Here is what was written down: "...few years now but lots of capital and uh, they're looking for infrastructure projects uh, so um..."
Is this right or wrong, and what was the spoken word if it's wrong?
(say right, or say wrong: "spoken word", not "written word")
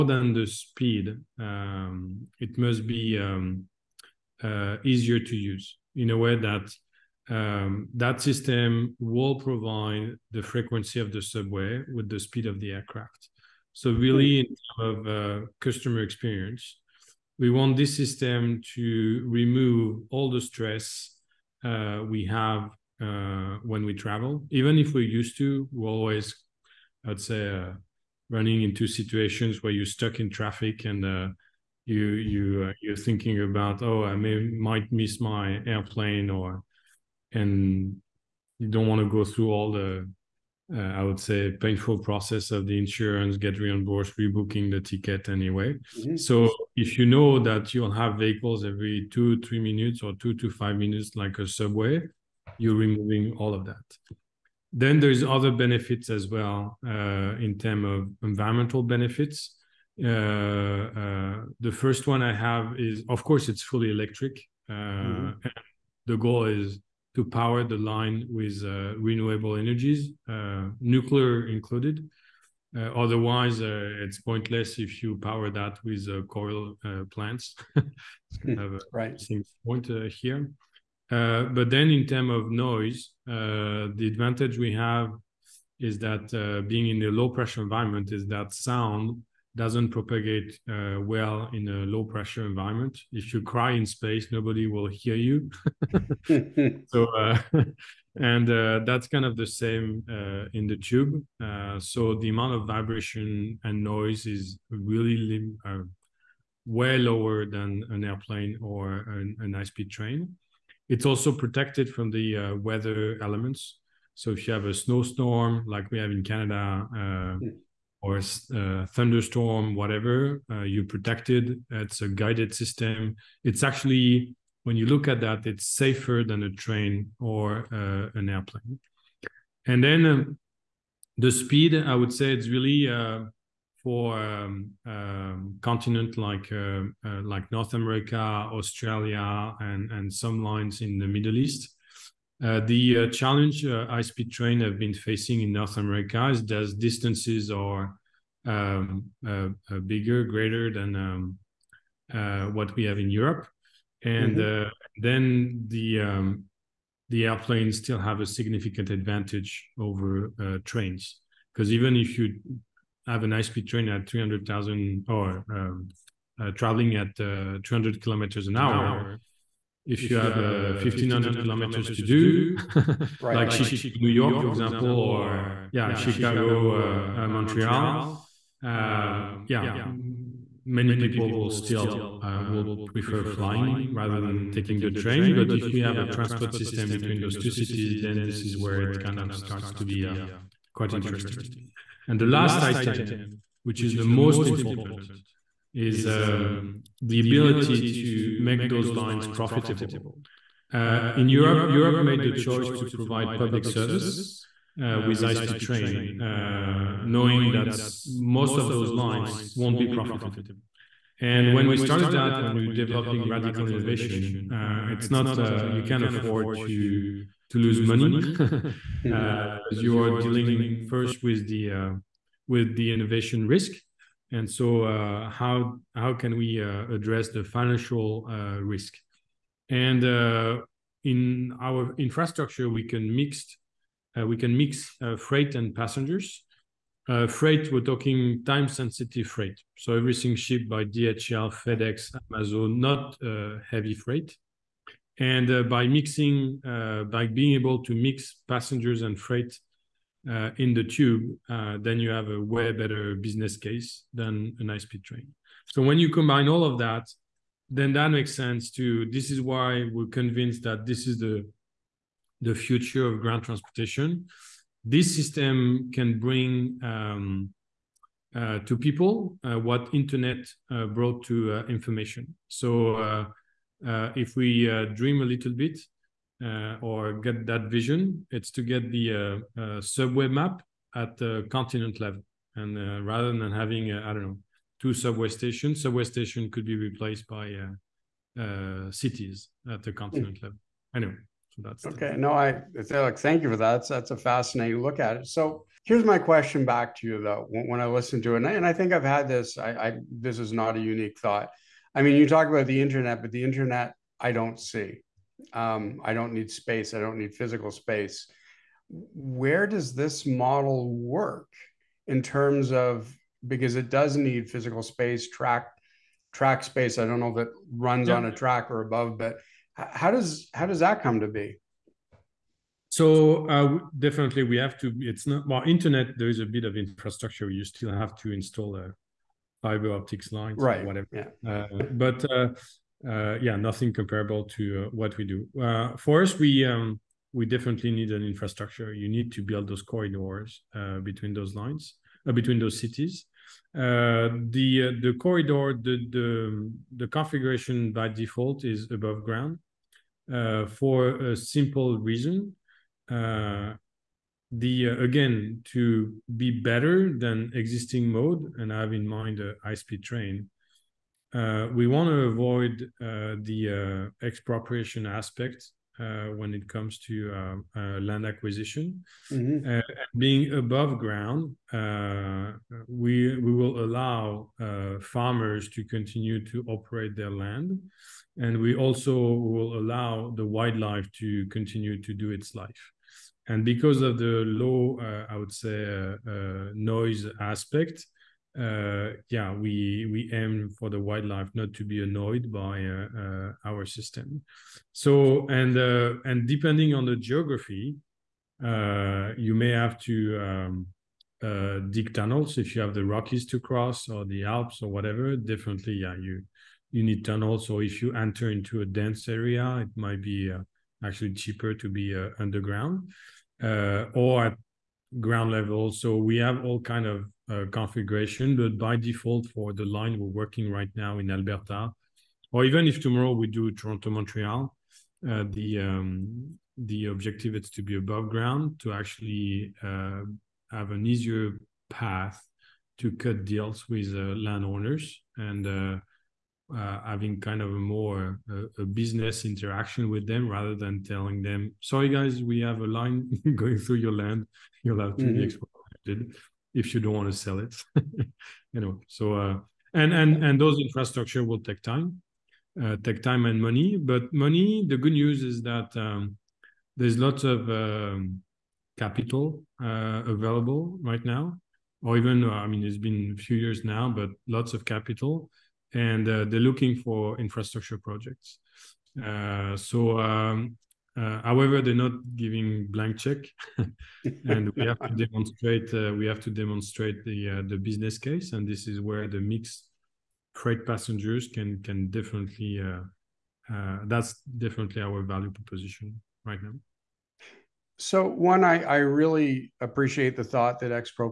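right.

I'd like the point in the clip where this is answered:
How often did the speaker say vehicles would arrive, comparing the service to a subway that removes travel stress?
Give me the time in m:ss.
0:48.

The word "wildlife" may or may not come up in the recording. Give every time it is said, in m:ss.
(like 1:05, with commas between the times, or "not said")
6:20, 6:30.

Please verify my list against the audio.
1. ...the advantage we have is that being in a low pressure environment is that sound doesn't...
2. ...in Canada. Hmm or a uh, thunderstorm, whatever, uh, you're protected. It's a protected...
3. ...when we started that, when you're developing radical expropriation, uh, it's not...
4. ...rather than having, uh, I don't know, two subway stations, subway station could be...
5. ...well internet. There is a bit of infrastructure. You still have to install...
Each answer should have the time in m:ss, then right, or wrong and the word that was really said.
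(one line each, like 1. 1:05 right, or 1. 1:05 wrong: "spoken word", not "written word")
1. 1:23 right
2. 1:56 wrong: "guided", not "protected"
3. 3:31 wrong: "innovation", not "expropriation"
4. 4:43 right
5. 5:25 right.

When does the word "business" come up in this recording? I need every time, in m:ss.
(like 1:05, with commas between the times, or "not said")
4:13, 7:18, 7:57.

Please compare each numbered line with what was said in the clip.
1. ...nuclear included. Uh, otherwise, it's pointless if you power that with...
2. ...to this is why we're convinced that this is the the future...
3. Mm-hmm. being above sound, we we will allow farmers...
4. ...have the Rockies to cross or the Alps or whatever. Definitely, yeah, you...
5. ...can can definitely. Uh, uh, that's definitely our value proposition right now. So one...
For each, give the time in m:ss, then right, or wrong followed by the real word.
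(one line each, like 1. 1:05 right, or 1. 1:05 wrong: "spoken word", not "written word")
1. 1:10 right
2. 4:18 right
3. 6:09 wrong: "ground", not "sound"
4. 6:42 right
5. 8:01 right.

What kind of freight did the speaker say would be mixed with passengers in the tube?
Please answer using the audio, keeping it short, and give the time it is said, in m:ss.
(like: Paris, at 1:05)
time sensitive freight, at 3:58.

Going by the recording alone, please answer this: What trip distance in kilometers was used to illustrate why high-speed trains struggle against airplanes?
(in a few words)
1500.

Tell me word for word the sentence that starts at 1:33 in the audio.
If you cry in space, nobody will hear you.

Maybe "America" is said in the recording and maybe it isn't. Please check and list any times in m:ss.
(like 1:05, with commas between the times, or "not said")
2:17, 2:25.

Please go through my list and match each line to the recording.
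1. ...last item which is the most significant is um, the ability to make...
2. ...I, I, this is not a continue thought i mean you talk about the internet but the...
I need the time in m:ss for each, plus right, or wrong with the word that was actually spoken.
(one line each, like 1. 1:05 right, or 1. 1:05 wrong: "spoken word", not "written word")
1. 3:12 wrong: "important", not "significant"
2. 4:59 wrong: "unique", not "continue".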